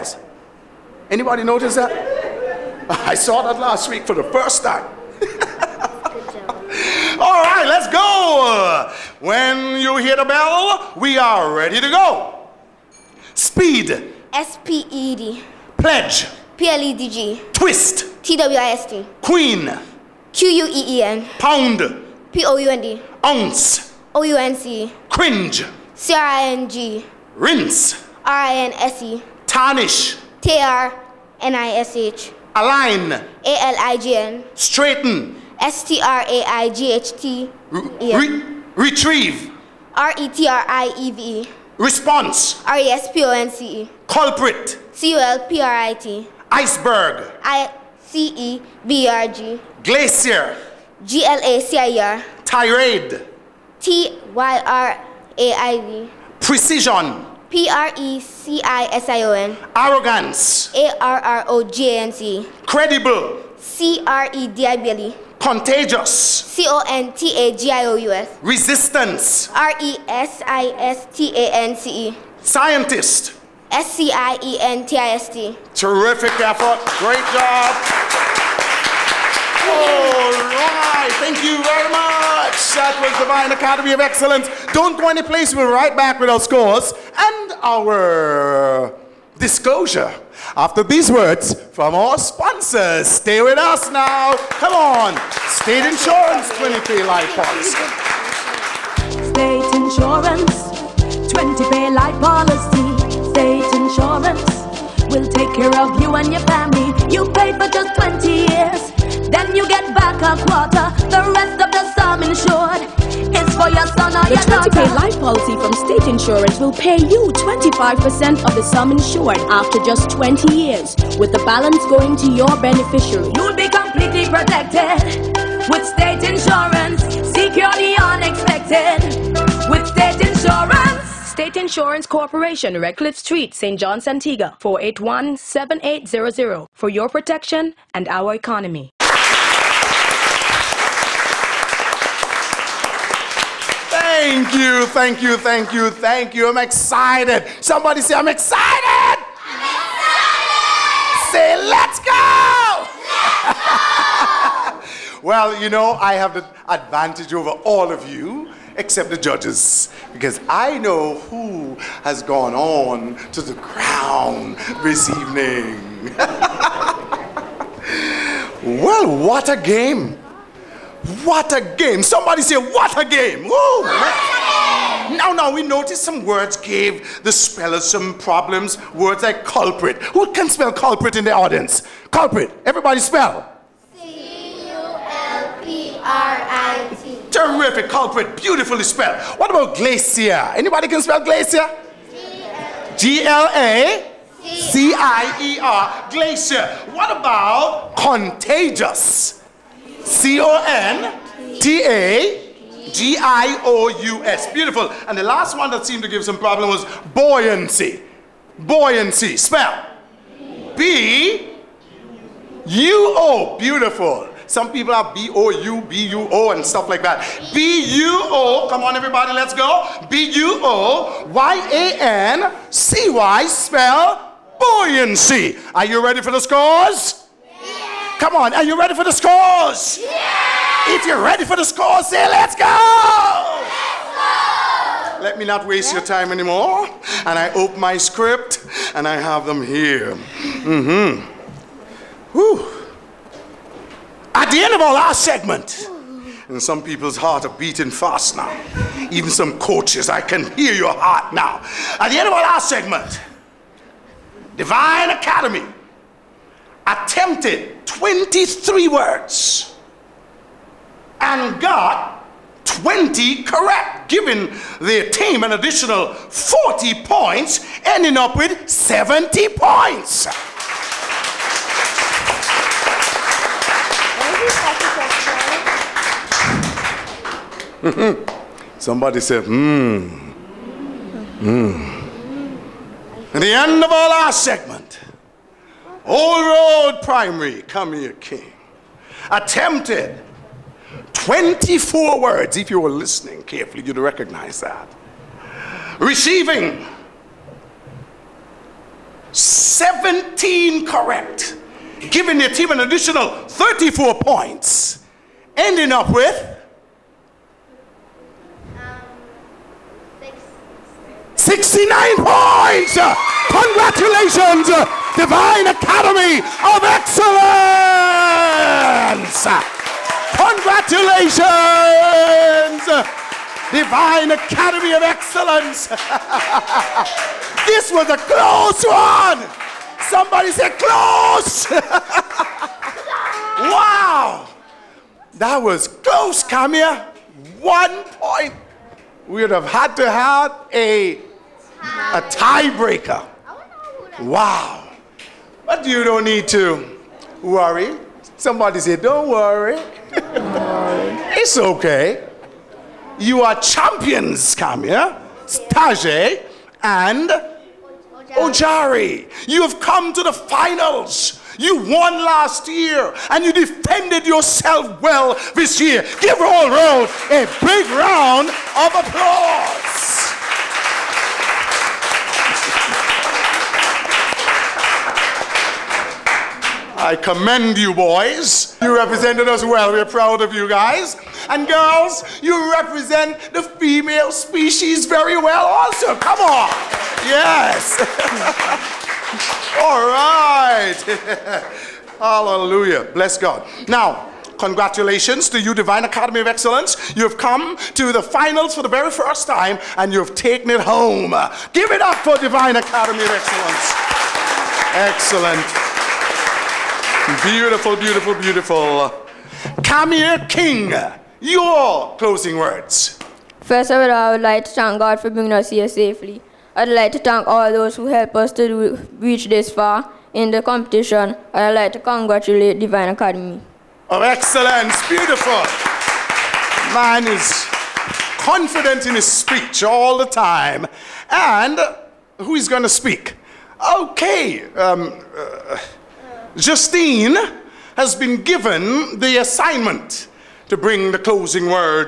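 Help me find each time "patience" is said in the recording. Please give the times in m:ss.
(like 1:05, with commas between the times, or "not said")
not said.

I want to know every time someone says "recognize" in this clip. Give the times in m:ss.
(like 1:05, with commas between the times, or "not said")
4:53.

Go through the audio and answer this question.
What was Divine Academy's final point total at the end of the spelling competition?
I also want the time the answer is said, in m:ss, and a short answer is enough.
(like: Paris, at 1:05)
70, at 4:28.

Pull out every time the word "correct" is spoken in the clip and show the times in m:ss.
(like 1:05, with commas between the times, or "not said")
4:23, 5:00.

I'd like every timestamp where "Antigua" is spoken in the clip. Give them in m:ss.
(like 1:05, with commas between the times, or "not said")
2:14.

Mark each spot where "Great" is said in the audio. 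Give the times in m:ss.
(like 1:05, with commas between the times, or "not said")
1:17.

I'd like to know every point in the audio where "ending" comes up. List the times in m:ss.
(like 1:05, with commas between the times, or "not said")
4:27, 5:05.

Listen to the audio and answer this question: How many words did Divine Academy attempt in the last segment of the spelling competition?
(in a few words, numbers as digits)
23.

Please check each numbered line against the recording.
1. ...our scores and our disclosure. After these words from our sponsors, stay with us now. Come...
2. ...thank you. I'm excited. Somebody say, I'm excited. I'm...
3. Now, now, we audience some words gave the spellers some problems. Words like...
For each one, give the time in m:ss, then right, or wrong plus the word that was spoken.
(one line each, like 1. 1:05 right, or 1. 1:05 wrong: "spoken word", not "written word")
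1. 1:26 right
2. 2:25 right
3. 2:55 wrong: "notice", not "audience".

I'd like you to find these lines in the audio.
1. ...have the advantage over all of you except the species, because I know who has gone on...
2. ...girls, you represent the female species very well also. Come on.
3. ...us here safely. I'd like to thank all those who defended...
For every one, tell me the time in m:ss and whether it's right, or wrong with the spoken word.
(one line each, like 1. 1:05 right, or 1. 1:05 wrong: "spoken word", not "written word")
1. 2:36 wrong: "judges", not "species"
2. 6:21 right
3. 6:55 wrong: "helped", not "defended".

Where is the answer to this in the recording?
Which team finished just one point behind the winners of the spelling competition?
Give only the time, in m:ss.
4:46.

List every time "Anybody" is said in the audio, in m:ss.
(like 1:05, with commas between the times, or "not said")
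0:01, 3:10.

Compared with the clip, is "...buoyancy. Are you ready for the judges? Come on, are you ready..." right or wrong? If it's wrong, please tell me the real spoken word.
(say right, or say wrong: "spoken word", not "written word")
wrong: "scores", not "judges".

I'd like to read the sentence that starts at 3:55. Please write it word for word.
Let me not waste your time anymore.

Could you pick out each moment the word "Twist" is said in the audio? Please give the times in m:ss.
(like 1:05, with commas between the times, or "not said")
0:17.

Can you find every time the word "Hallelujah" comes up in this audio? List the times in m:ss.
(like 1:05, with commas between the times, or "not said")
6:32.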